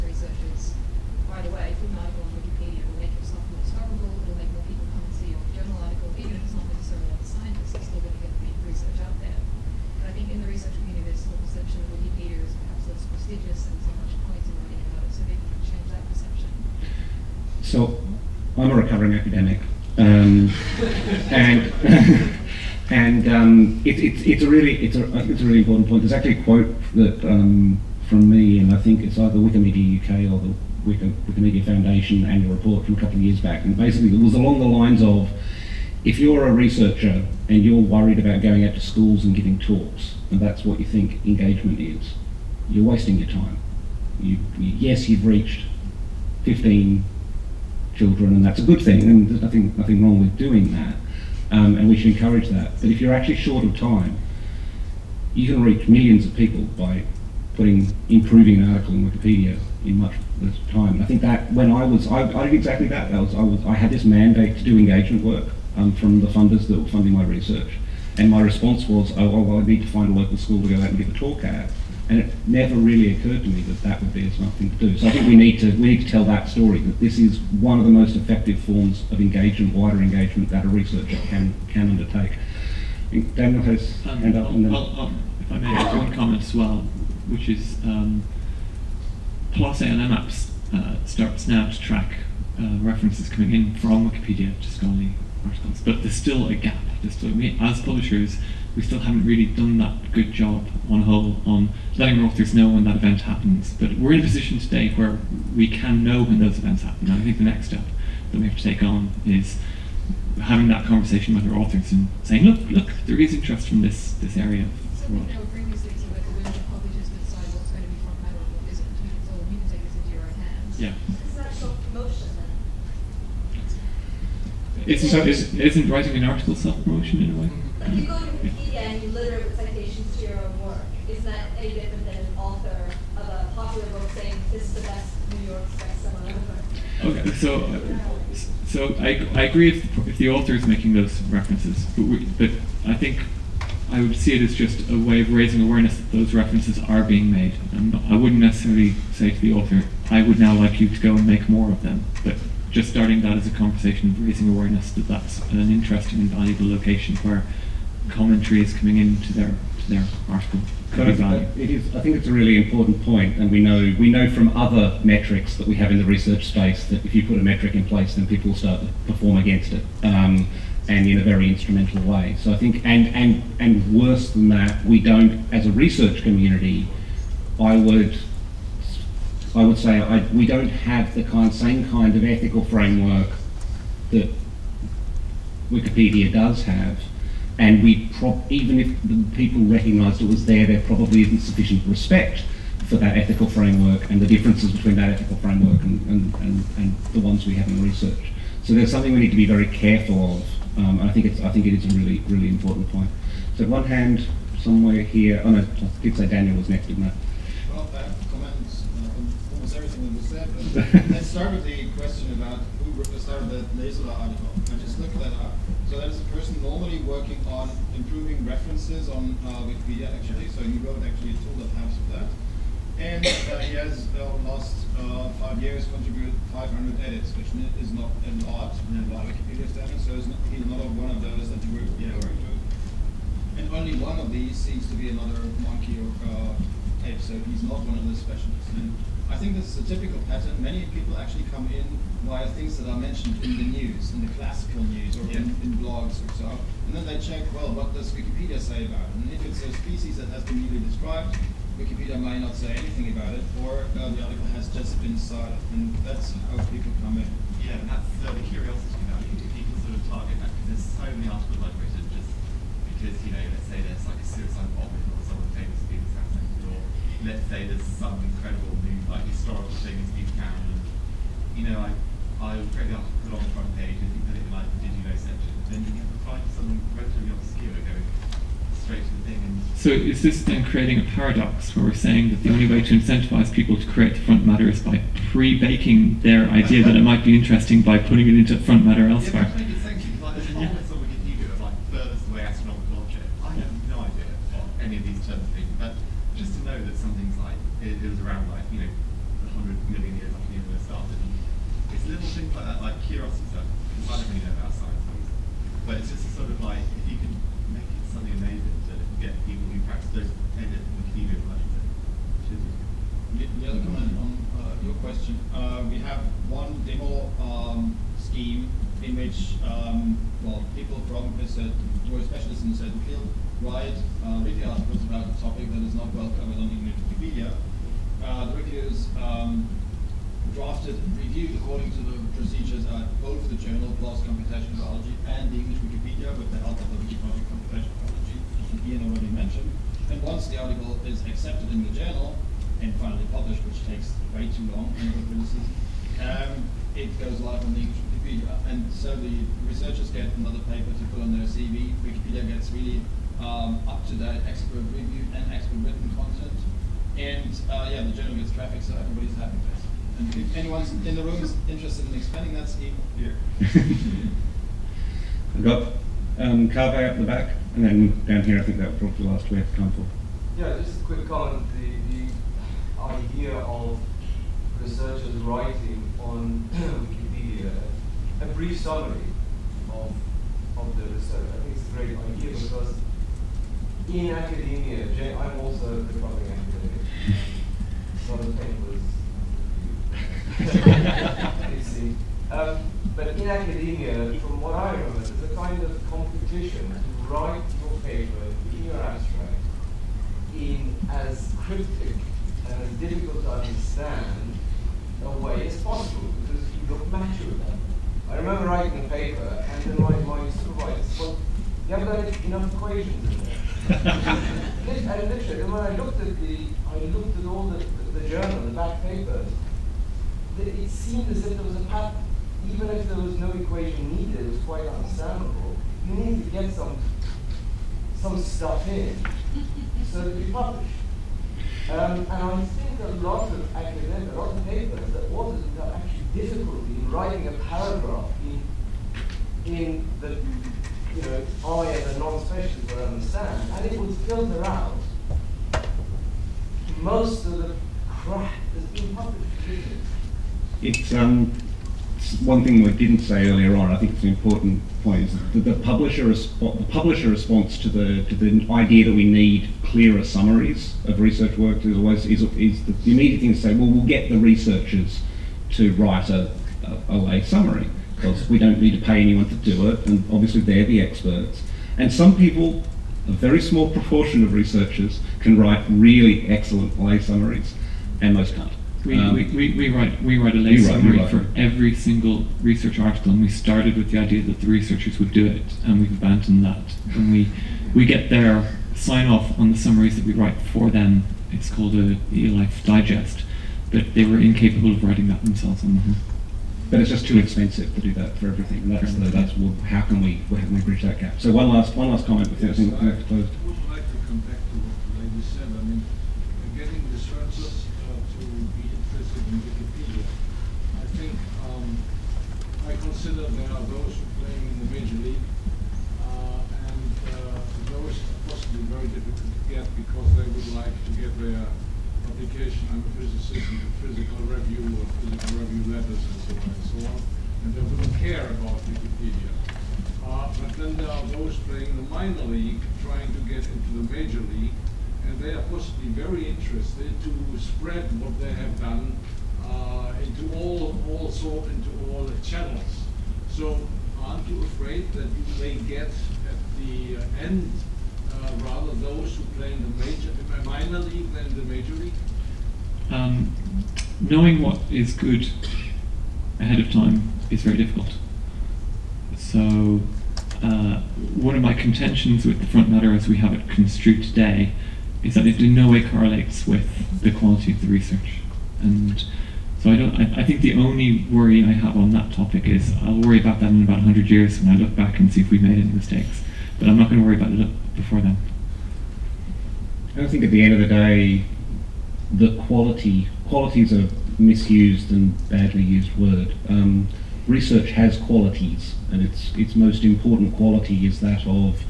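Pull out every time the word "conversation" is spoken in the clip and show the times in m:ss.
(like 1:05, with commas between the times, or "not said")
1:50, 2:33.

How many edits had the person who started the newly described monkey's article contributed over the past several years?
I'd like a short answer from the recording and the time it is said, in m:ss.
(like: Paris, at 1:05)
500, at 3:46.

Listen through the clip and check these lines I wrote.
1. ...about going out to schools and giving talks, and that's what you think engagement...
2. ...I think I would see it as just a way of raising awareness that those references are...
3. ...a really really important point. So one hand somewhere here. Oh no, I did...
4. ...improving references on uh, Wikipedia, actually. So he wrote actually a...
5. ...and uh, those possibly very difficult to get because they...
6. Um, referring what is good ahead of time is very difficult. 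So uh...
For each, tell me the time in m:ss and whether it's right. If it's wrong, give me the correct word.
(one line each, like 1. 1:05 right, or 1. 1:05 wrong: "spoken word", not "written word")
1. 0:38 right
2. 2:22 right
3. 3:21 right
4. 3:37 right
5. 8:36 right
6. 9:13 wrong: "knowing", not "referring".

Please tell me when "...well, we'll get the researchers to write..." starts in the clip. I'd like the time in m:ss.
7:43.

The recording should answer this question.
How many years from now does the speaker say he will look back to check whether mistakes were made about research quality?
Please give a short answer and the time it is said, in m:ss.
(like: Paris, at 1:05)
100, at 9:33.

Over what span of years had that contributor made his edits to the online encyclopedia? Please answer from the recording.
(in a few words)
five years.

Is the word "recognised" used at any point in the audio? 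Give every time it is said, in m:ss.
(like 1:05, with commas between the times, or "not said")
3:09.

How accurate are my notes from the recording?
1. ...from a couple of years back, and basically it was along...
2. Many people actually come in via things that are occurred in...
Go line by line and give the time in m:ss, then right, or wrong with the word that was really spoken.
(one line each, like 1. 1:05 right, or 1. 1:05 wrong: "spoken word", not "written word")
1. 0:32 right
2. 4:00 wrong: "mentioned", not "occurred".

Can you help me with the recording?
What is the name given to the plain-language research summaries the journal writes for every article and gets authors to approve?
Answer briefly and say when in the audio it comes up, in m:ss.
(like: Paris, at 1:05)
eLife Digest, at 8:12.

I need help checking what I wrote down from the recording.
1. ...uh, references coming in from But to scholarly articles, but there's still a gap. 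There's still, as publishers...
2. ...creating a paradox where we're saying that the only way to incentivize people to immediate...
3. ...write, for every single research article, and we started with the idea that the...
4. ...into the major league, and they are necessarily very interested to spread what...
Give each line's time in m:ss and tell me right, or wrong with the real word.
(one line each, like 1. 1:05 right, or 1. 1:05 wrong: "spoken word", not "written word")
1. 1:32 wrong: "Wikipedia", not "But"
2. 4:40 wrong: "create", not "immediate"
3. 8:01 right
4. 8:53 wrong: "possibly", not "necessarily".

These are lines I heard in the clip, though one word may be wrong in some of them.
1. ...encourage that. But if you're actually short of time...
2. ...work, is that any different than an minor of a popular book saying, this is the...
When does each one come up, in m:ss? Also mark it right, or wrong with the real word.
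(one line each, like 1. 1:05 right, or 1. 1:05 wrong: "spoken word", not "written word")
1. 0:52 right
2. 2:10 wrong: "author", not "minor".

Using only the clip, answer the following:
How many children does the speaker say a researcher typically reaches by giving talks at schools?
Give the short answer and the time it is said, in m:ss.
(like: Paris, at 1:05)
15, at 0:46.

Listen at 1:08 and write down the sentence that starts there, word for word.
And my response was, oh, well, I need to find a local school to go out and give a talk at.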